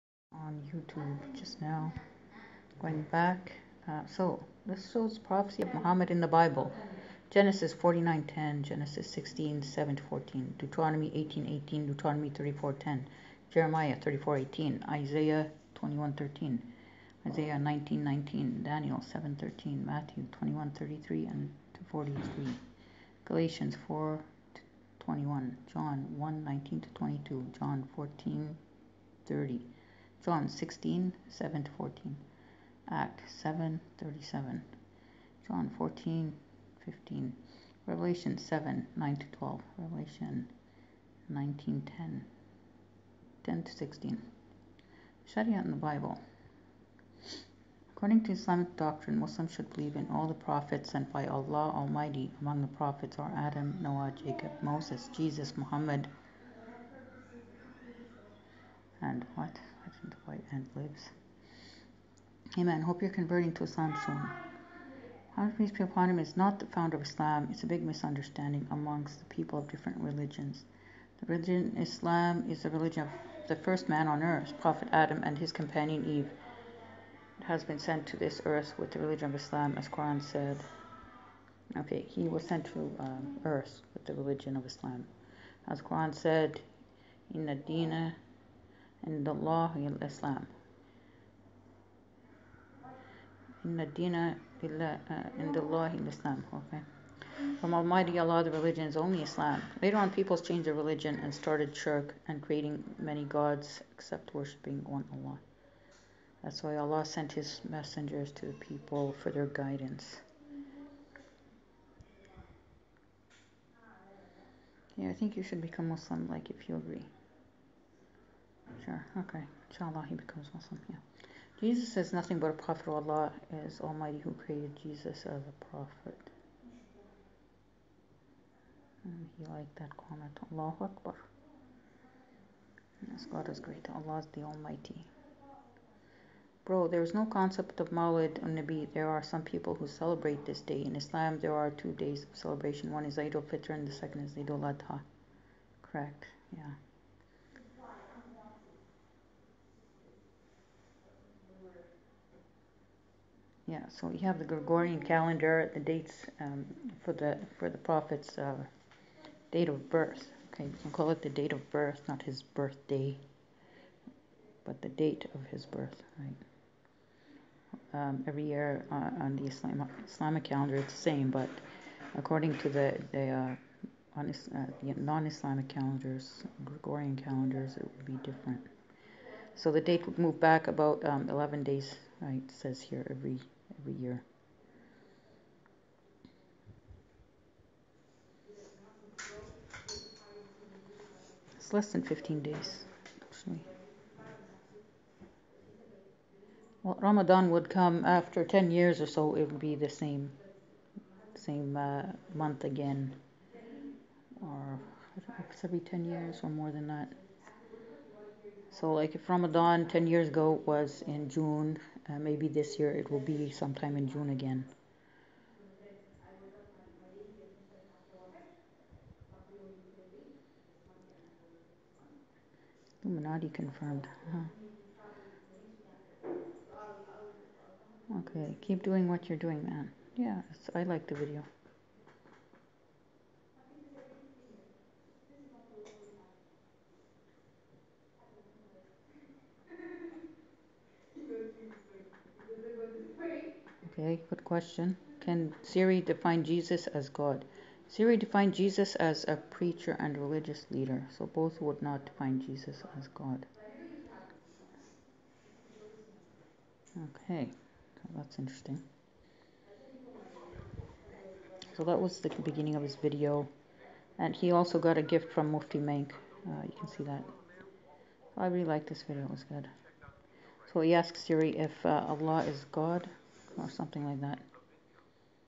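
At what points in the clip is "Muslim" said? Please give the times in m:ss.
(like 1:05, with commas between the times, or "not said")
0:49, 1:55, 2:00.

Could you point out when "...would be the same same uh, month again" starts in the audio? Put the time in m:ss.
3:19.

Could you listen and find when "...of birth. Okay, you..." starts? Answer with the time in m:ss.
2:39.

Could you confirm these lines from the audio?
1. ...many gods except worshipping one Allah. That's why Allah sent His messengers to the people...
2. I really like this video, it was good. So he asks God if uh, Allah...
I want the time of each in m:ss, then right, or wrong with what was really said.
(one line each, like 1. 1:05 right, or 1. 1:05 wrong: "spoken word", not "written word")
1. 1:42 right
2. 4:28 wrong: "Siri", not "God".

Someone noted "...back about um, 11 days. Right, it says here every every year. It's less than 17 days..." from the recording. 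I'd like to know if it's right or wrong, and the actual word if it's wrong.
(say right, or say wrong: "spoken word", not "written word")
wrong: "15", not "17".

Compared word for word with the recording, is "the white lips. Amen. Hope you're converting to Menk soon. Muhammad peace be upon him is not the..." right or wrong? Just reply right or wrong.
wrong.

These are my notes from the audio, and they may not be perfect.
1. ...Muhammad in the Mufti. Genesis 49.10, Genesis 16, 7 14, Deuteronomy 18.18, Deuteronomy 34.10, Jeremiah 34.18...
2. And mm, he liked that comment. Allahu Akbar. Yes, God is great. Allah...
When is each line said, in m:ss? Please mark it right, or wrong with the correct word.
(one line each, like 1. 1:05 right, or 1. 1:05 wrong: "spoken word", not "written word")
1. 0:05 wrong: "Bible", not "Mufti"
2. 2:09 right.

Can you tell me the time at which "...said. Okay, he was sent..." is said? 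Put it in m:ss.
1:20.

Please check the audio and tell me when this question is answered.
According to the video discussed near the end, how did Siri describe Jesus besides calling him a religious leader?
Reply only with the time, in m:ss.
4:09.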